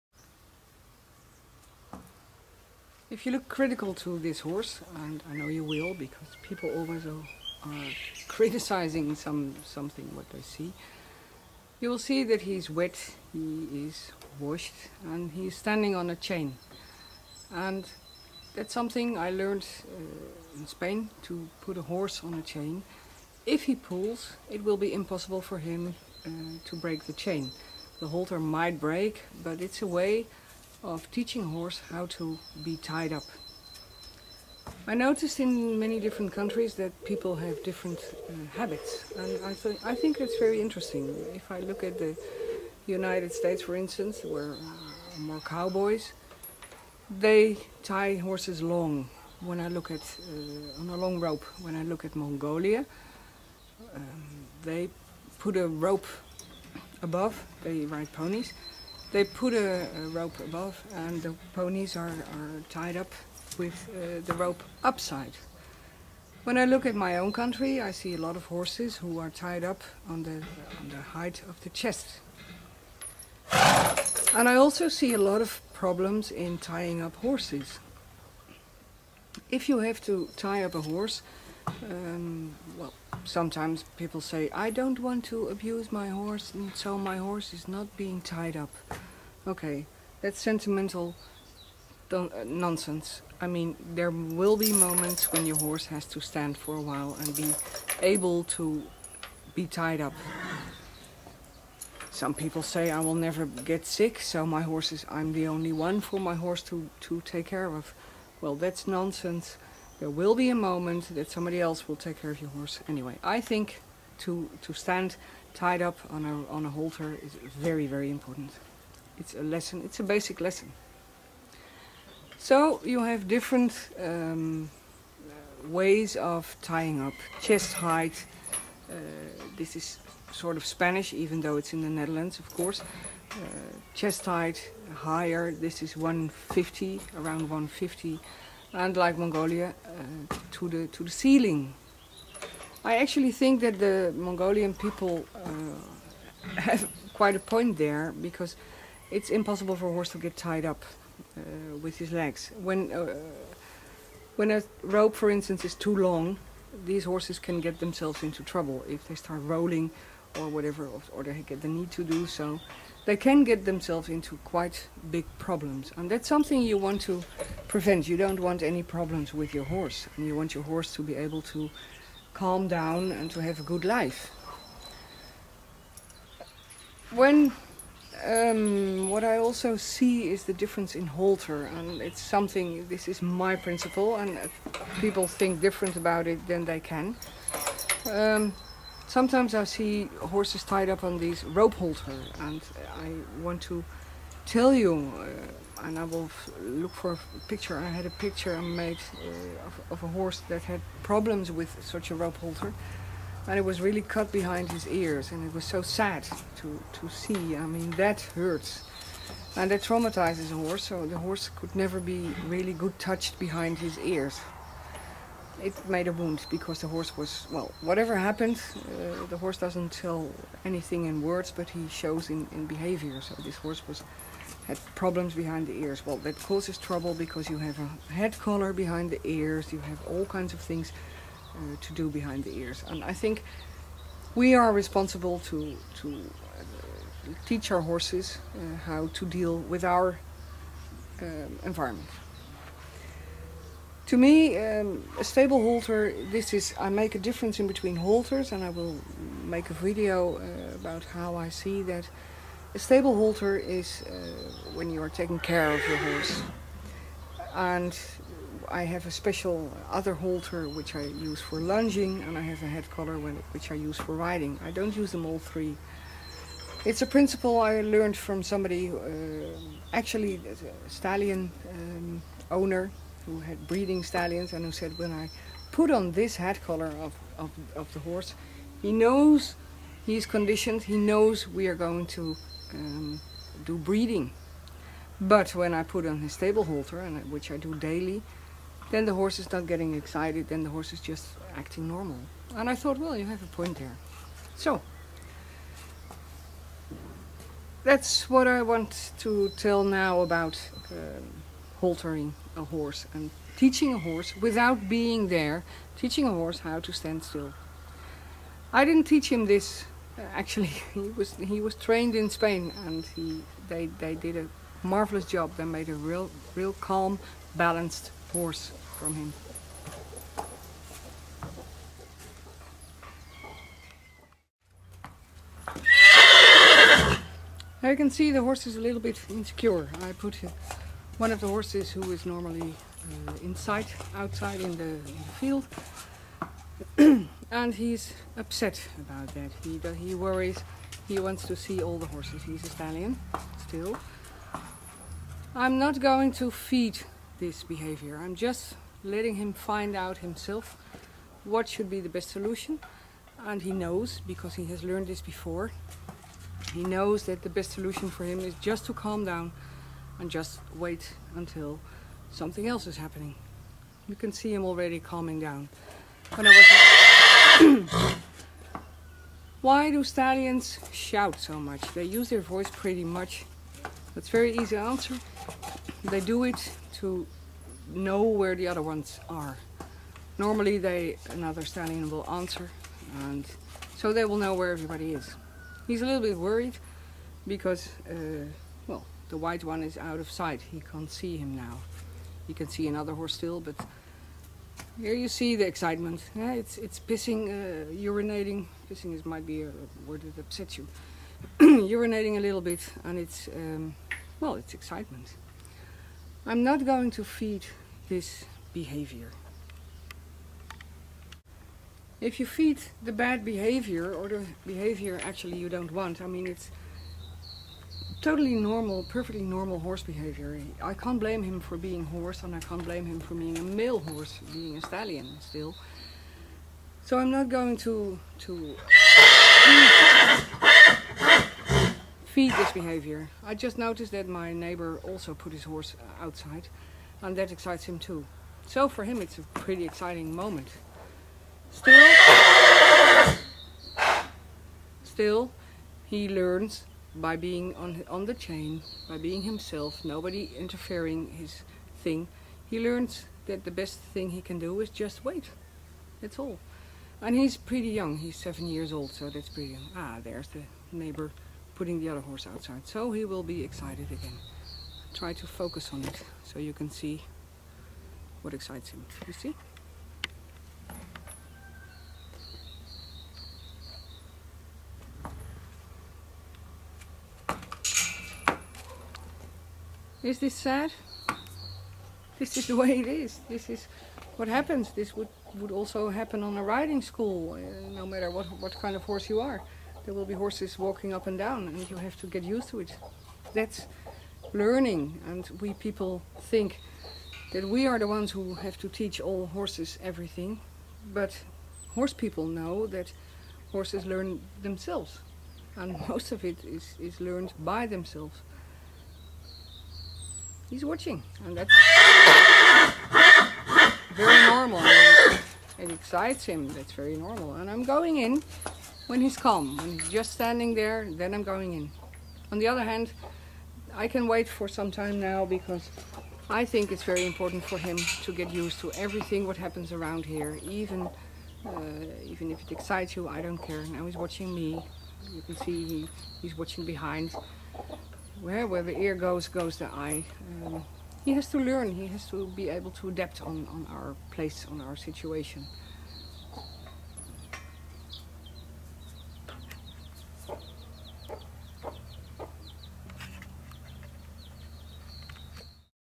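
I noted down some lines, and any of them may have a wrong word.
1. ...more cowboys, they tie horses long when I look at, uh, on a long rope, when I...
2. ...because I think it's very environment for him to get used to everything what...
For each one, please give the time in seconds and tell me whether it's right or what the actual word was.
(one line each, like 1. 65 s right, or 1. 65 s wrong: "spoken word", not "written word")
1. 45 s right
2. 525 s wrong: "important", not "environment".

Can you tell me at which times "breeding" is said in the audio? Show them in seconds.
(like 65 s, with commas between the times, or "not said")
273 s, 283 s.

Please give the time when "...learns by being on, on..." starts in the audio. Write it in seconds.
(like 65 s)
446 s.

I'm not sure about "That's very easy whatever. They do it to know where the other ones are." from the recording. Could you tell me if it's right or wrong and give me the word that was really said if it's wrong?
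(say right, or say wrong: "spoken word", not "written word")
wrong: "answer", not "whatever".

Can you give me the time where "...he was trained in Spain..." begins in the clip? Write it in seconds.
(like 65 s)
311 s.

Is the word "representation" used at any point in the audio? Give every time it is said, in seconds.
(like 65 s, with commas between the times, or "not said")
not said.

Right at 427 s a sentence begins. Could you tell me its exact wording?
So I'm not going to to feed this behavior.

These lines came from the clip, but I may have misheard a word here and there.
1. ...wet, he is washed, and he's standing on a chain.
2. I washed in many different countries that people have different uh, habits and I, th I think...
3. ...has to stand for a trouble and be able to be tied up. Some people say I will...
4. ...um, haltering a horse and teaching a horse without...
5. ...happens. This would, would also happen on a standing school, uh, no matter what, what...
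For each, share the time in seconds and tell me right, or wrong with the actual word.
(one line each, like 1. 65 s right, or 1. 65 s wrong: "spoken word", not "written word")
1. 12 s right
2. 34 s wrong: "noticed", not "washed"
3. 95 s wrong: "while", not "trouble"
4. 300 s right
5. 484 s wrong: "riding", not "standing".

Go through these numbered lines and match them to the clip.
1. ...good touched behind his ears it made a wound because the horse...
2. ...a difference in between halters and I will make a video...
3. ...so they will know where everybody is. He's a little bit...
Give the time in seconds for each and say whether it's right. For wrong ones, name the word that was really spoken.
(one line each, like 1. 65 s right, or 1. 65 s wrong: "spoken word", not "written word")
1. 212 s right
2. 247 s right
3. 383 s right.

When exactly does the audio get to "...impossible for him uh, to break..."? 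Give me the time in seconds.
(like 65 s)
24 s.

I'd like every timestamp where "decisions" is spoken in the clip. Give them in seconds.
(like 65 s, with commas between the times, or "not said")
not said.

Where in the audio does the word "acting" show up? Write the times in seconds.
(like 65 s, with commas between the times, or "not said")
291 s.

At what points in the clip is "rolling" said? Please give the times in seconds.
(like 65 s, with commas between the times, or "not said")
159 s.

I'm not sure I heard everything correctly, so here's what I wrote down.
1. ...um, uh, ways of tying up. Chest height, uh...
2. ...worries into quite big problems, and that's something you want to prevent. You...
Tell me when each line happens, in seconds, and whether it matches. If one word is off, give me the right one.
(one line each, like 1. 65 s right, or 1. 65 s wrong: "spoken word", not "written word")
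1. 124 s right
2. 163 s wrong: "themselves", not "worries".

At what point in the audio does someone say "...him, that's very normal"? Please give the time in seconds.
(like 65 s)
516 s.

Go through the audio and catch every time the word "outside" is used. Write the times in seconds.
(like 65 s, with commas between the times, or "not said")
334 s, 436 s, 462 s.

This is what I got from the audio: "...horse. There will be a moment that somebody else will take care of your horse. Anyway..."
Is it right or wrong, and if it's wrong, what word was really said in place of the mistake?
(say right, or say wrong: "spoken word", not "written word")
wrong: "nonsense", not "horse".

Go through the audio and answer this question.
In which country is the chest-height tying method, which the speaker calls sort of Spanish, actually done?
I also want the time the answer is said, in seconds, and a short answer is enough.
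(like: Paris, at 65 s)
Netherlands, at 131 s.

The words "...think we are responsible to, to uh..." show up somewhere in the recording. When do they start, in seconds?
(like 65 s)
233 s.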